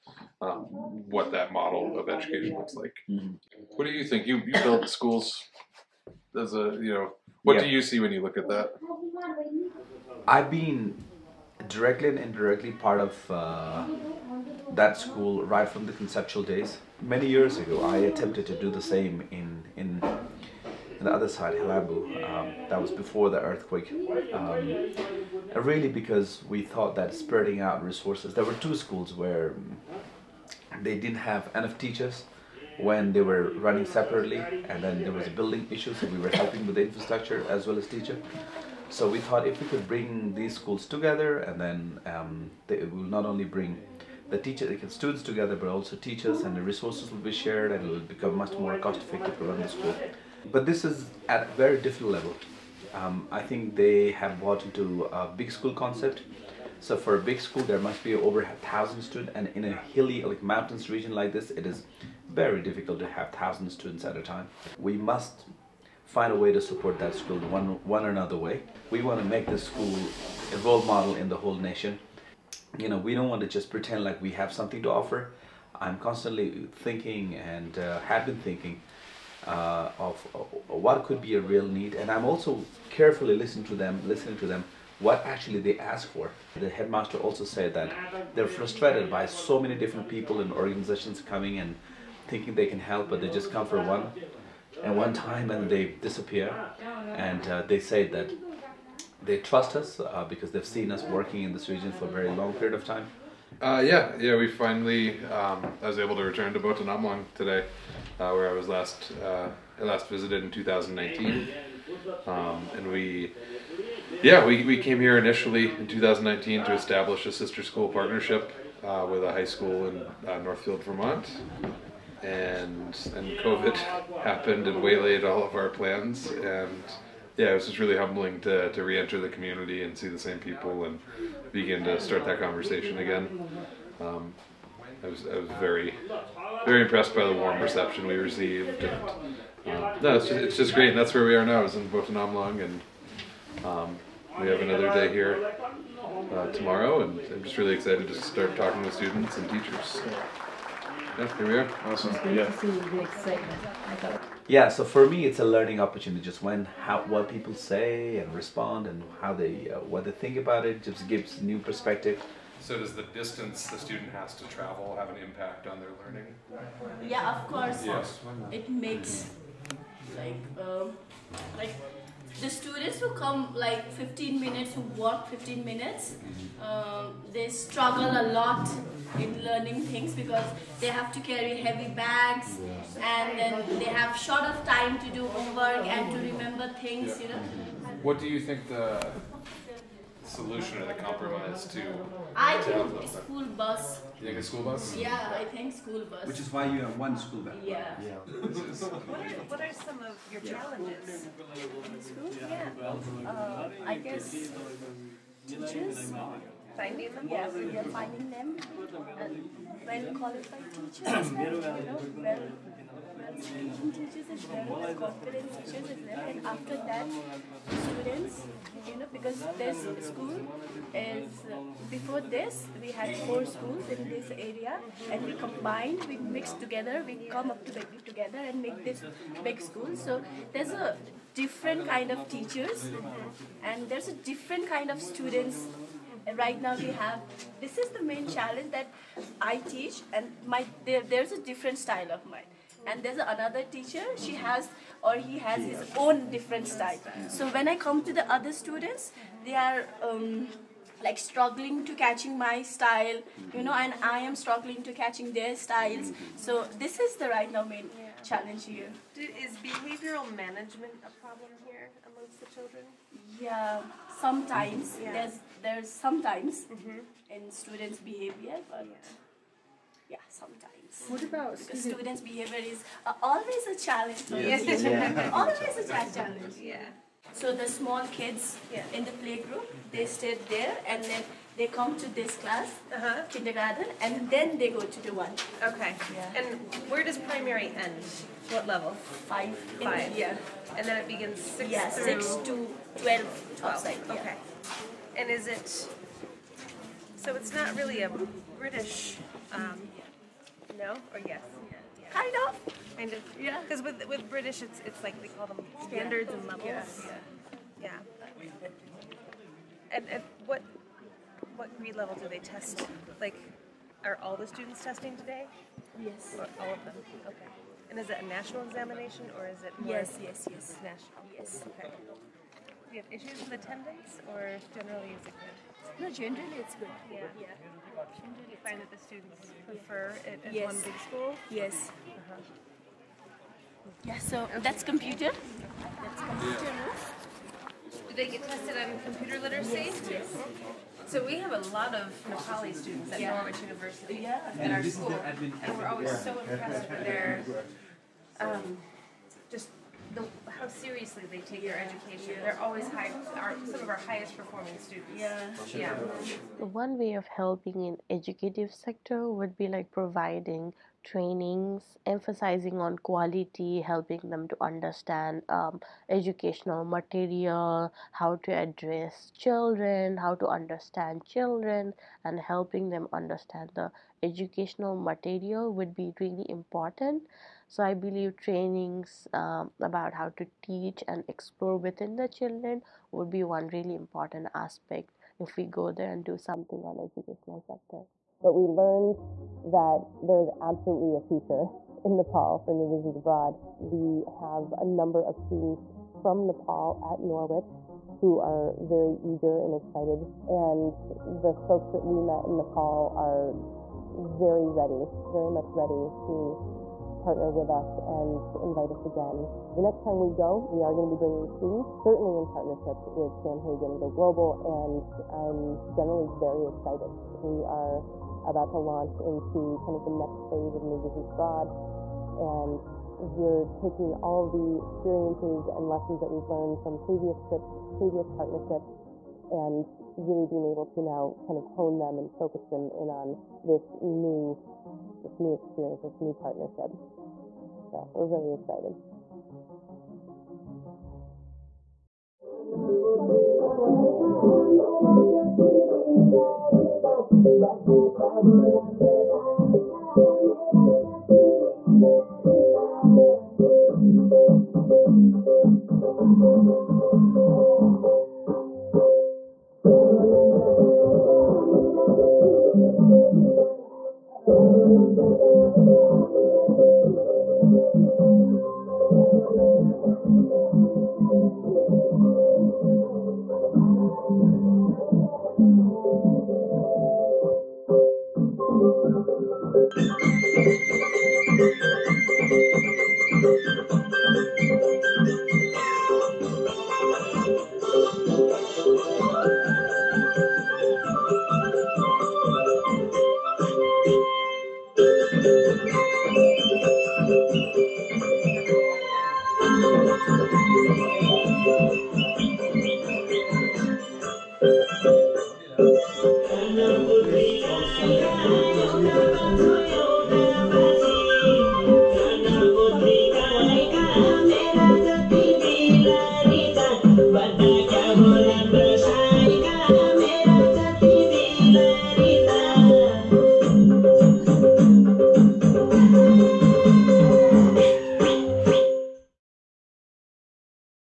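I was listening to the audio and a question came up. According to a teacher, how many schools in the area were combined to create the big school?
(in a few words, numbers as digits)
Four.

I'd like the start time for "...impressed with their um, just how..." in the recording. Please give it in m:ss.
5:46.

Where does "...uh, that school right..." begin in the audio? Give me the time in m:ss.
0:13.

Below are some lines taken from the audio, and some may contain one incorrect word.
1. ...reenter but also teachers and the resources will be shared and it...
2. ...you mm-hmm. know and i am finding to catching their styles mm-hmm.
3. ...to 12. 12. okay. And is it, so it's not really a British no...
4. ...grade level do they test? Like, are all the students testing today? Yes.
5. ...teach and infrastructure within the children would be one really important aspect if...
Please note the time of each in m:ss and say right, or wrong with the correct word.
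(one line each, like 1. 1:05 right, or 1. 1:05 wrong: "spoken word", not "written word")
1. 0:45 wrong: "together", not "reenter"
2. 4:13 wrong: "struggling", not "finding"
3. 4:52 right
4. 5:11 right
5. 6:20 wrong: "explore", not "infrastructure".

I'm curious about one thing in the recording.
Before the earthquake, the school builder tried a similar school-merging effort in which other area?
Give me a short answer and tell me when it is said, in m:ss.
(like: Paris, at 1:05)
Helambu, at 0:21.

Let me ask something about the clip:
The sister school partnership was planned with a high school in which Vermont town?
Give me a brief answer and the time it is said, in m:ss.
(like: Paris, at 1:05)
Northfield, at 2:00.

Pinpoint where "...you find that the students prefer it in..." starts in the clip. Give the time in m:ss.
5:28.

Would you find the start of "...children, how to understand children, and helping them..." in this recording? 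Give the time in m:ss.
6:09.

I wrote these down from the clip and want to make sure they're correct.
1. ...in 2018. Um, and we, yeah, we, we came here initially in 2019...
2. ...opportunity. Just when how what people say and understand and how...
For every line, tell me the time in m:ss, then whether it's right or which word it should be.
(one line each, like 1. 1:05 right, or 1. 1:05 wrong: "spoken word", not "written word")
1. 1:50 wrong: "2019", not "2018"
2. 2:35 wrong: "respond", not "understand".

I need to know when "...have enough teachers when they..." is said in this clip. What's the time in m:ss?
0:31.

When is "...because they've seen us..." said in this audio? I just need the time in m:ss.
1:40.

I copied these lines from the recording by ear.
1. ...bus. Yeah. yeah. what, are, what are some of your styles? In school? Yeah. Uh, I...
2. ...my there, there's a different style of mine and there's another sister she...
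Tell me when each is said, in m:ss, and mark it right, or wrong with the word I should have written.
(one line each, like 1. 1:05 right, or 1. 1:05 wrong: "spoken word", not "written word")
1. 3:17 wrong: "challenges", not "styles"
2. 4:00 wrong: "teacher", not "sister".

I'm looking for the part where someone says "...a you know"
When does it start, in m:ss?
0:06.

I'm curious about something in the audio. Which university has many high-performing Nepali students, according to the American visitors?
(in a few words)
Norwich University.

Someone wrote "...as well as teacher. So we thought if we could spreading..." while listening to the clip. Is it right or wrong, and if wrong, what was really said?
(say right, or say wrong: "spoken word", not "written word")
wrong: "bring", not "spreading".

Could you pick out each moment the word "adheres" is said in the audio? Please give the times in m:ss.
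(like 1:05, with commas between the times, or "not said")
not said.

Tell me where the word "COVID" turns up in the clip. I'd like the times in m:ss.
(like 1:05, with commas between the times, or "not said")
2:03.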